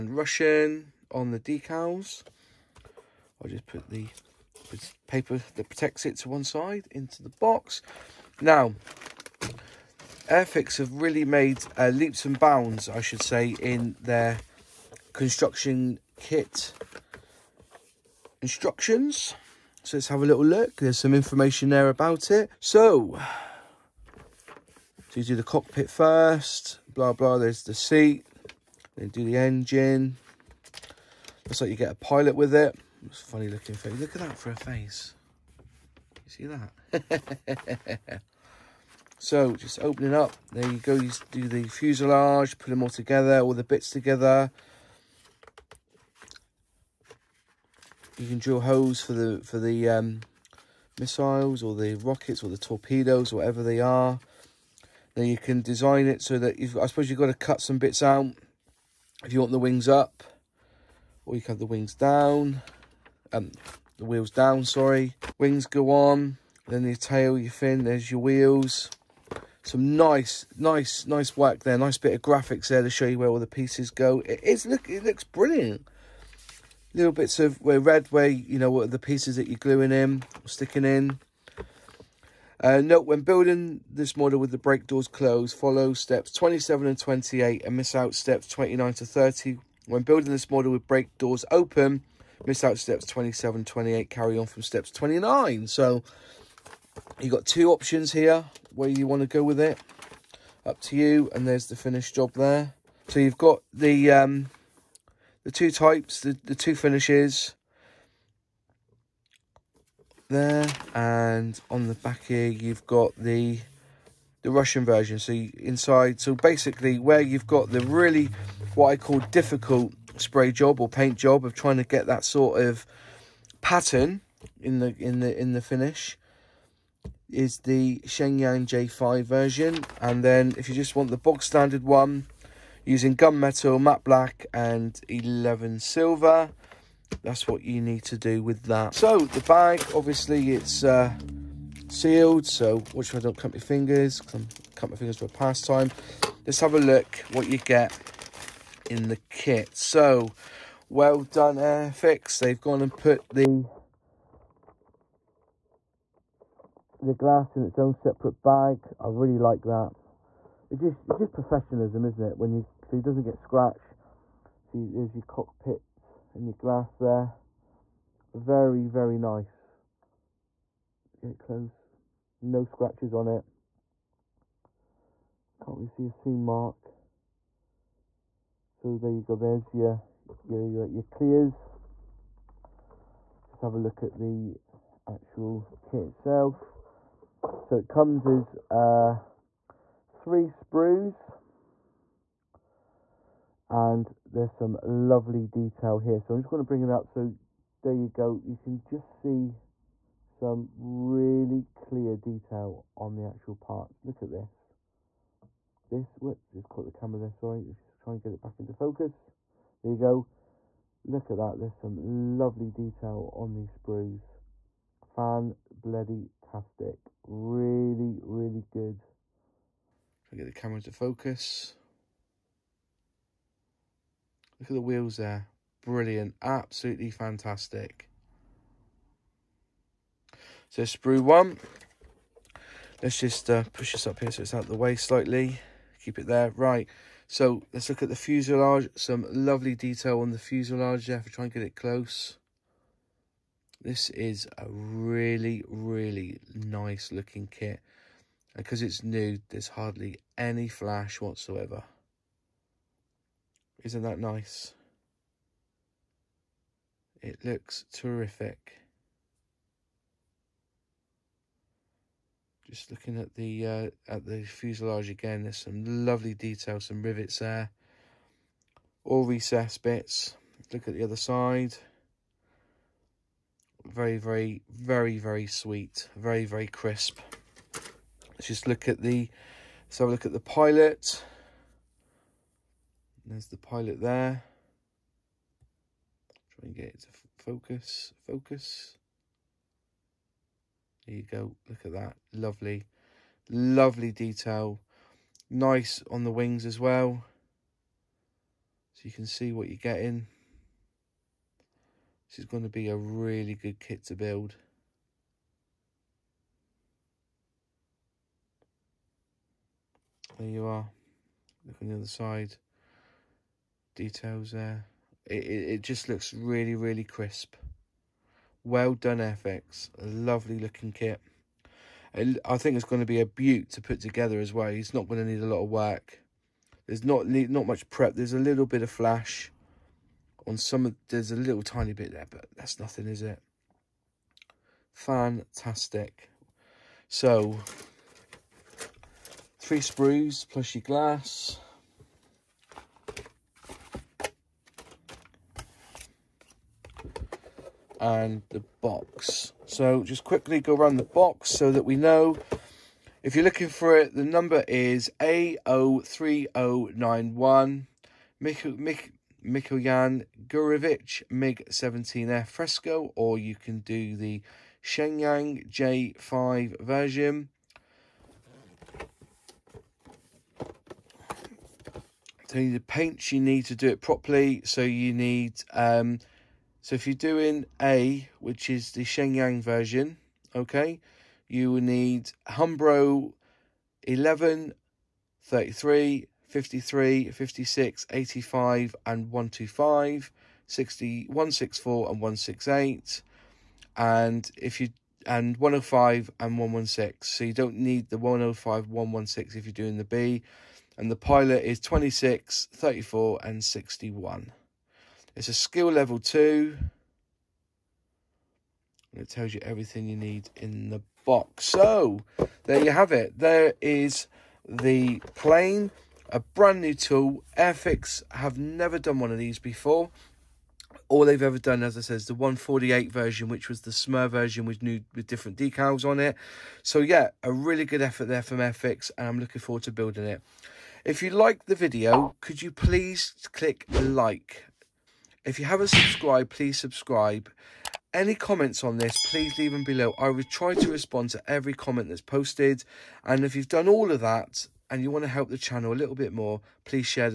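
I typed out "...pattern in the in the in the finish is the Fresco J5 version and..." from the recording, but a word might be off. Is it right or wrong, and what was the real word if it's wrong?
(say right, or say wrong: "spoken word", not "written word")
wrong: "Shenyang", not "Fresco".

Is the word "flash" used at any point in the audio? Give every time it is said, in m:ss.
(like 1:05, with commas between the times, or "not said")
4:10, 5:28.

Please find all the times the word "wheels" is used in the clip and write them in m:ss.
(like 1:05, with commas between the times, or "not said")
1:04, 1:08, 3:44.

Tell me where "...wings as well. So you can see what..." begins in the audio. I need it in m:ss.
4:56.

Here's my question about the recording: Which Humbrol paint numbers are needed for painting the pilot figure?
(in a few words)
26, 34, and 61.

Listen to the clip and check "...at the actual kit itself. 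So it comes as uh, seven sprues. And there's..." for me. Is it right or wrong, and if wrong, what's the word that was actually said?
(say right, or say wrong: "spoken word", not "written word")
wrong: "three", not "seven".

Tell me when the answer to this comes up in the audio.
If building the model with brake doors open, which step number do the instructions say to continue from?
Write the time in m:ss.
1:34.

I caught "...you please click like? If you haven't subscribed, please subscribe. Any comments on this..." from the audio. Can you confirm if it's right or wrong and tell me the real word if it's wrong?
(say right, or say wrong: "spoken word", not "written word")
right.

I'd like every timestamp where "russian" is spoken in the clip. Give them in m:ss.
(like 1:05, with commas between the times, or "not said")
0:00, 1:54.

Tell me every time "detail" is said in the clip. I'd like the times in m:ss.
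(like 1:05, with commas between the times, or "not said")
3:15, 3:22, 3:32, 3:59, 4:26, 4:54, 5:13.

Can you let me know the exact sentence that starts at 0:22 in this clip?
So, so you do the cockpit first, blah, blah.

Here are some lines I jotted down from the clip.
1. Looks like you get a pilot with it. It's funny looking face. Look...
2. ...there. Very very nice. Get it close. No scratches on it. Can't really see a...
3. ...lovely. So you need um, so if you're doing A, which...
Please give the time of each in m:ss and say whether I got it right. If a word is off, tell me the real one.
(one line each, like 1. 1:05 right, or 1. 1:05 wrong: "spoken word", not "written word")
1. 0:31 right
2. 2:46 right
3. 6:14 wrong: "properly", not "lovely".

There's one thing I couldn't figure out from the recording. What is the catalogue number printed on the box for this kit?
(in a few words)
A03091.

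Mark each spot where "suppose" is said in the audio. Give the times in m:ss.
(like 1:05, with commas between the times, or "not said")
0:56.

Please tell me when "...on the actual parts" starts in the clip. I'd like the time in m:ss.
3:22.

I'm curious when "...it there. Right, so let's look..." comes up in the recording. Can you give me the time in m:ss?
3:56.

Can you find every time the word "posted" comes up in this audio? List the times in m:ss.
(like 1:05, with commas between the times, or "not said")
7:22.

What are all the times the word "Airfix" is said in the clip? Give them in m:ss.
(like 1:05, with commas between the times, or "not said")
0:10, 2:31, 6:57, 7:08.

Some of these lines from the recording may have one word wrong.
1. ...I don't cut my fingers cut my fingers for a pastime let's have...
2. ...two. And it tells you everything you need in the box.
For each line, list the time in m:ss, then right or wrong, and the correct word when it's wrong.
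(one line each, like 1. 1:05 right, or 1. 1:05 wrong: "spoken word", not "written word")
1. 2:23 right
2. 6:46 right.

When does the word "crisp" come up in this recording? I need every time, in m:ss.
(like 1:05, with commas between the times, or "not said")
4:36, 5:17.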